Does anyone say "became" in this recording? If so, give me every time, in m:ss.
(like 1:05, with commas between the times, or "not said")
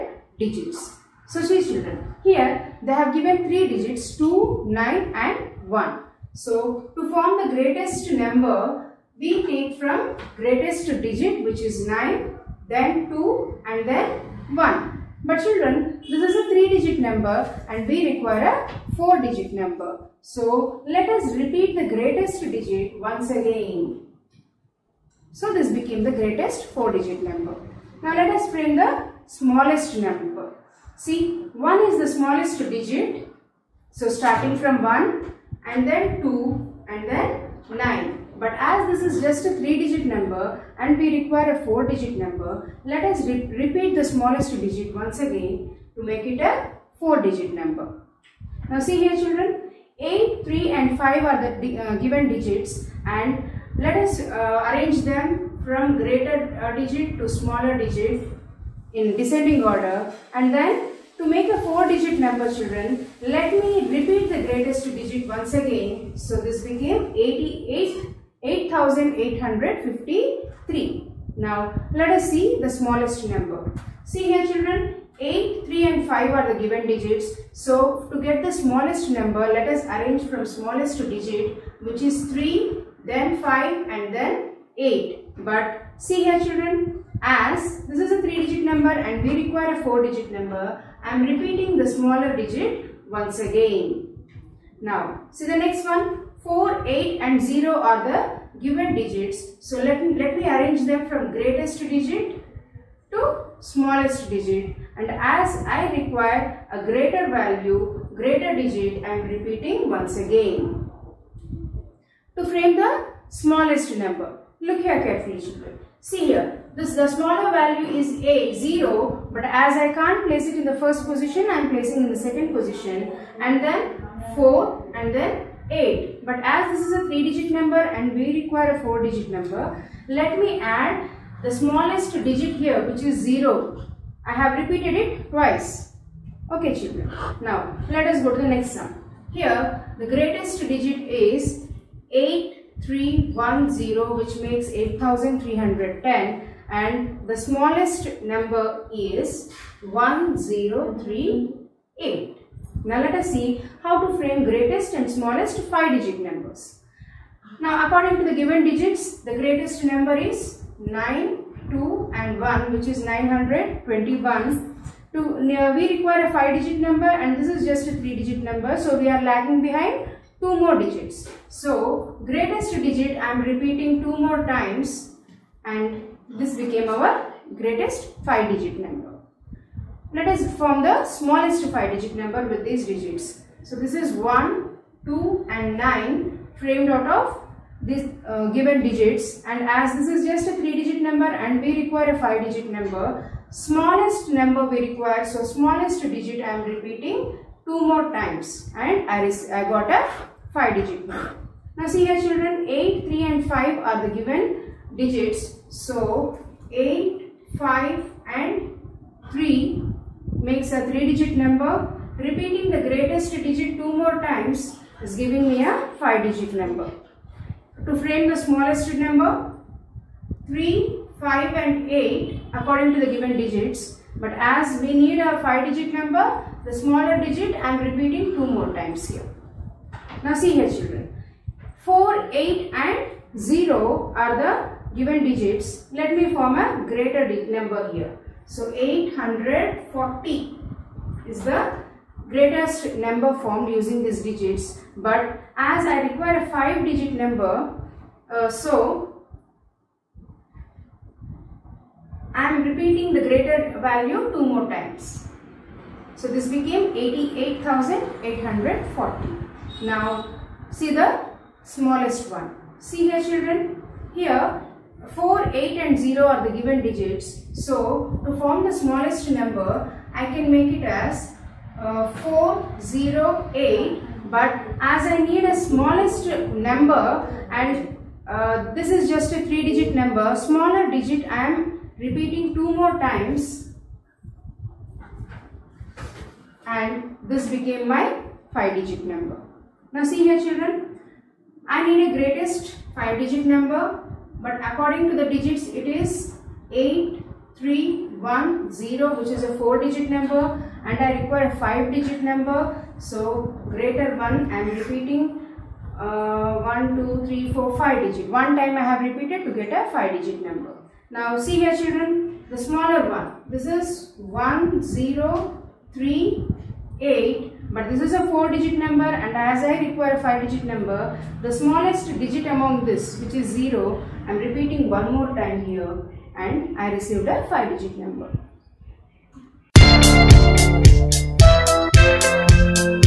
0:25, 1:06, 2:56, 4:16, 4:47.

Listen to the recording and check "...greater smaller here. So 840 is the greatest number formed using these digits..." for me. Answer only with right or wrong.
wrong.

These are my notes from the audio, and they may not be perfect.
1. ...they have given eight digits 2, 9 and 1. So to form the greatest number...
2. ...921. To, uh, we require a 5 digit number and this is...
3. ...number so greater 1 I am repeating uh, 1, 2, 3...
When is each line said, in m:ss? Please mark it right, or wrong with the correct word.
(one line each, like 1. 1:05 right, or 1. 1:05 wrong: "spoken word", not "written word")
1. 0:02 wrong: "three", not "eight"
2. 2:43 right
3. 5:02 right.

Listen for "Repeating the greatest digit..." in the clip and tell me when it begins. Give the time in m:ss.
3:32.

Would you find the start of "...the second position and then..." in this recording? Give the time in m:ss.
2:02.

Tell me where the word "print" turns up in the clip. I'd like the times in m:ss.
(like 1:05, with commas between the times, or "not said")
0:28.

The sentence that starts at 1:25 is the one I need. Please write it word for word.
But see here children as this is a 3 digit number and we require a 4 digit number.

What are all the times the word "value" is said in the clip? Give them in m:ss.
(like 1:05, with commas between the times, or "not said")
1:47, 1:57, 4:13.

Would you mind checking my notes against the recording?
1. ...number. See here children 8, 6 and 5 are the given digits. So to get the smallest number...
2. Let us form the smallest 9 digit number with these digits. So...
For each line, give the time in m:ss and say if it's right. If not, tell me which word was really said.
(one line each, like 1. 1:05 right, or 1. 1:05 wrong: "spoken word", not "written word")
1. 1:13 wrong: "3", not "6"
2. 3:00 wrong: "5", not "9".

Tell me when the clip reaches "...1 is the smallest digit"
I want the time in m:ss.
0:31.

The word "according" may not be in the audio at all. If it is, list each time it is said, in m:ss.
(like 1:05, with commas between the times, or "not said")
2:37, 3:42, 4:54.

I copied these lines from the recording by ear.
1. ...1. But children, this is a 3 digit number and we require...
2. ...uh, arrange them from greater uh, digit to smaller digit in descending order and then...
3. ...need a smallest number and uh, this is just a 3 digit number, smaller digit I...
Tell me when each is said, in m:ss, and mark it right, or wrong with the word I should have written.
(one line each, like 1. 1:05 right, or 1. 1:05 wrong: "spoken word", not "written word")
1. 0:14 right
2. 0:54 right
3. 4:35 right.